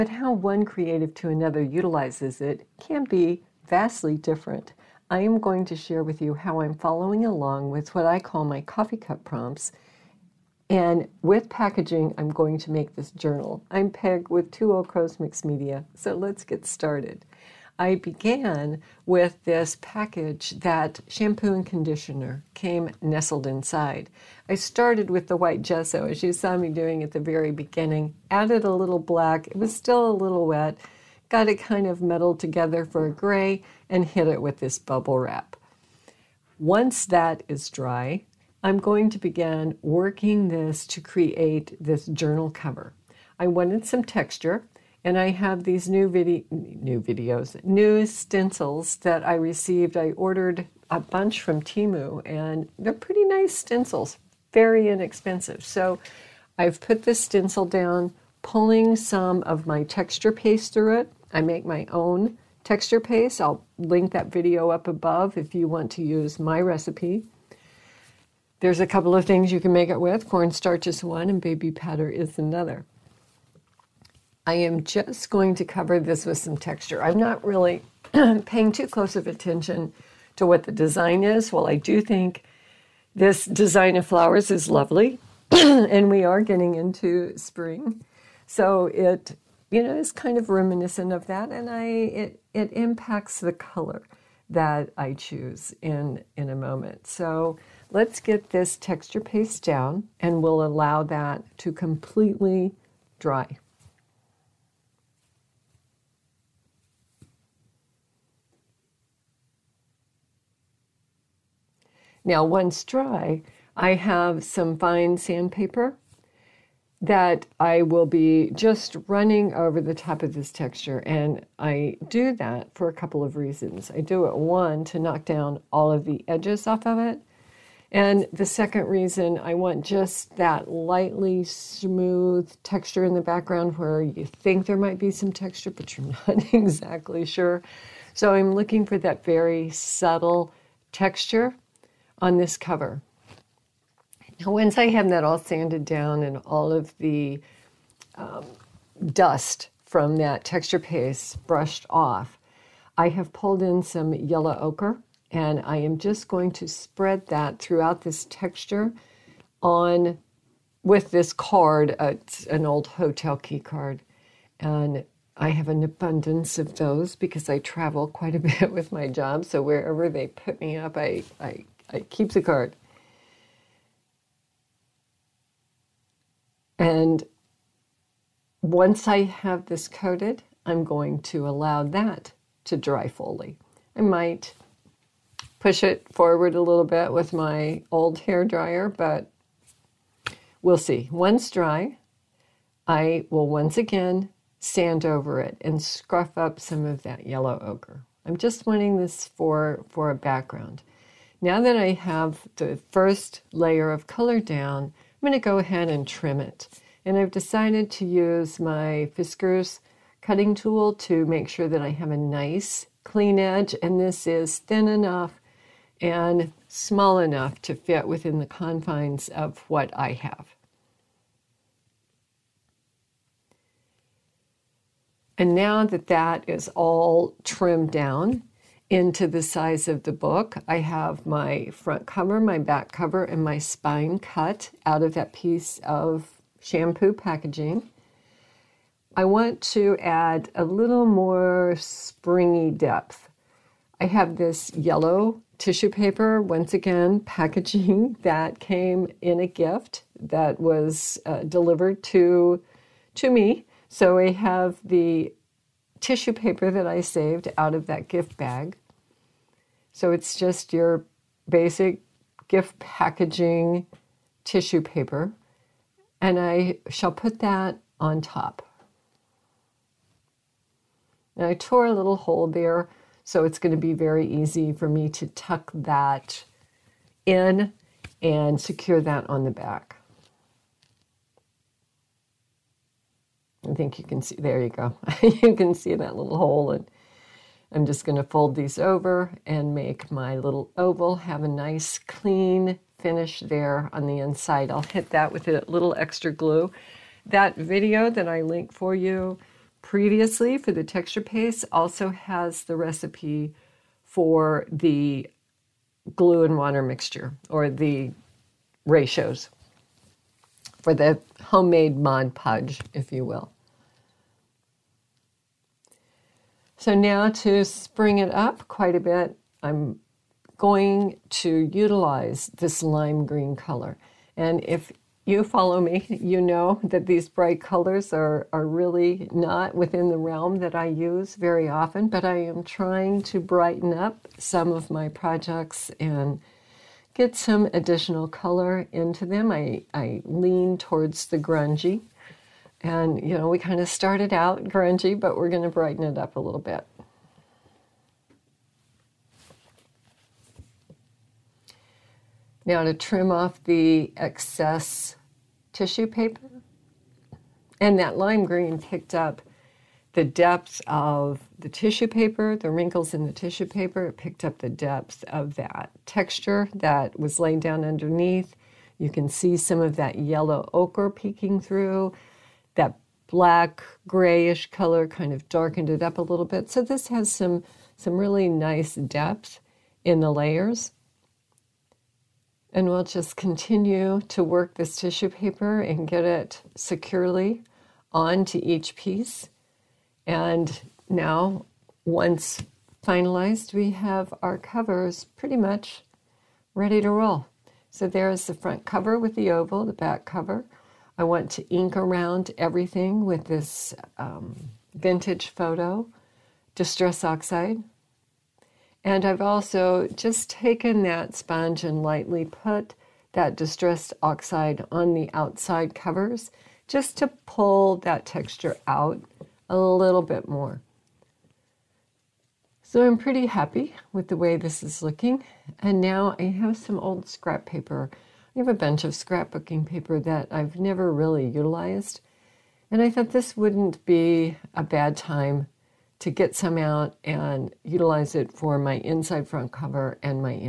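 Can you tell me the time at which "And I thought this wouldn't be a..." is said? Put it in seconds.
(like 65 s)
432 s.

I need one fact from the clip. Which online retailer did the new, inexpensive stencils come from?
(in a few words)
Temu.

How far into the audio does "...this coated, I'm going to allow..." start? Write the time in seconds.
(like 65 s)
179 s.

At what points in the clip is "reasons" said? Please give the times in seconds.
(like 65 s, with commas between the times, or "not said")
123 s, 128 s.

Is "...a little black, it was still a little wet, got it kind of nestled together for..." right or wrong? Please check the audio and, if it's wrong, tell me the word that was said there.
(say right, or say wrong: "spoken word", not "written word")
wrong: "meddled", not "nestled".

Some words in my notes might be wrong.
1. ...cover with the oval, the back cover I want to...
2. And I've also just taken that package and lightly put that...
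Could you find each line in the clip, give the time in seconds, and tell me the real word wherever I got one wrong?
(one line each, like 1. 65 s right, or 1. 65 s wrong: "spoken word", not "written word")
1. 398 s right
2. 409 s wrong: "sponge", not "package".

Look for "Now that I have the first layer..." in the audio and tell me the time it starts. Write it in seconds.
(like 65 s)
201 s.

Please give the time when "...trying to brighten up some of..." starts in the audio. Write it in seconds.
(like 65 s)
332 s.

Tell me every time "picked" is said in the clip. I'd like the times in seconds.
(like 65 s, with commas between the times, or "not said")
358 s, 364 s.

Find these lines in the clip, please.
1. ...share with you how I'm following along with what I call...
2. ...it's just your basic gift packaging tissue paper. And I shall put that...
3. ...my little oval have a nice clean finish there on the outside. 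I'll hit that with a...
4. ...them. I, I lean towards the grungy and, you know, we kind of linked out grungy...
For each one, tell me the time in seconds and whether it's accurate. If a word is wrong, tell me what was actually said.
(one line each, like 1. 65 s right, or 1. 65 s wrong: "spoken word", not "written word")
1. 5 s right
2. 260 s right
3. 290 s wrong: "inside", not "outside"
4. 339 s wrong: "started", not "linked".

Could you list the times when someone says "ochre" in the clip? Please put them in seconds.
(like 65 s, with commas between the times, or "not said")
154 s, 197 s, 370 s.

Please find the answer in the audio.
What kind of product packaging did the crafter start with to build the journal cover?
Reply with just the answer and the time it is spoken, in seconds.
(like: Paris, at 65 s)
Shampoo and conditioner, at 21 s.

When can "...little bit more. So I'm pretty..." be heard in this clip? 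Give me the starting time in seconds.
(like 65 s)
419 s.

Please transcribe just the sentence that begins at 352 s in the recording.
Now to trim off the excess tissue paper.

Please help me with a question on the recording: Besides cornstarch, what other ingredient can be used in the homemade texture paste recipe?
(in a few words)
Baby powder.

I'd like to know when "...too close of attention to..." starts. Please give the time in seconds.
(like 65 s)
78 s.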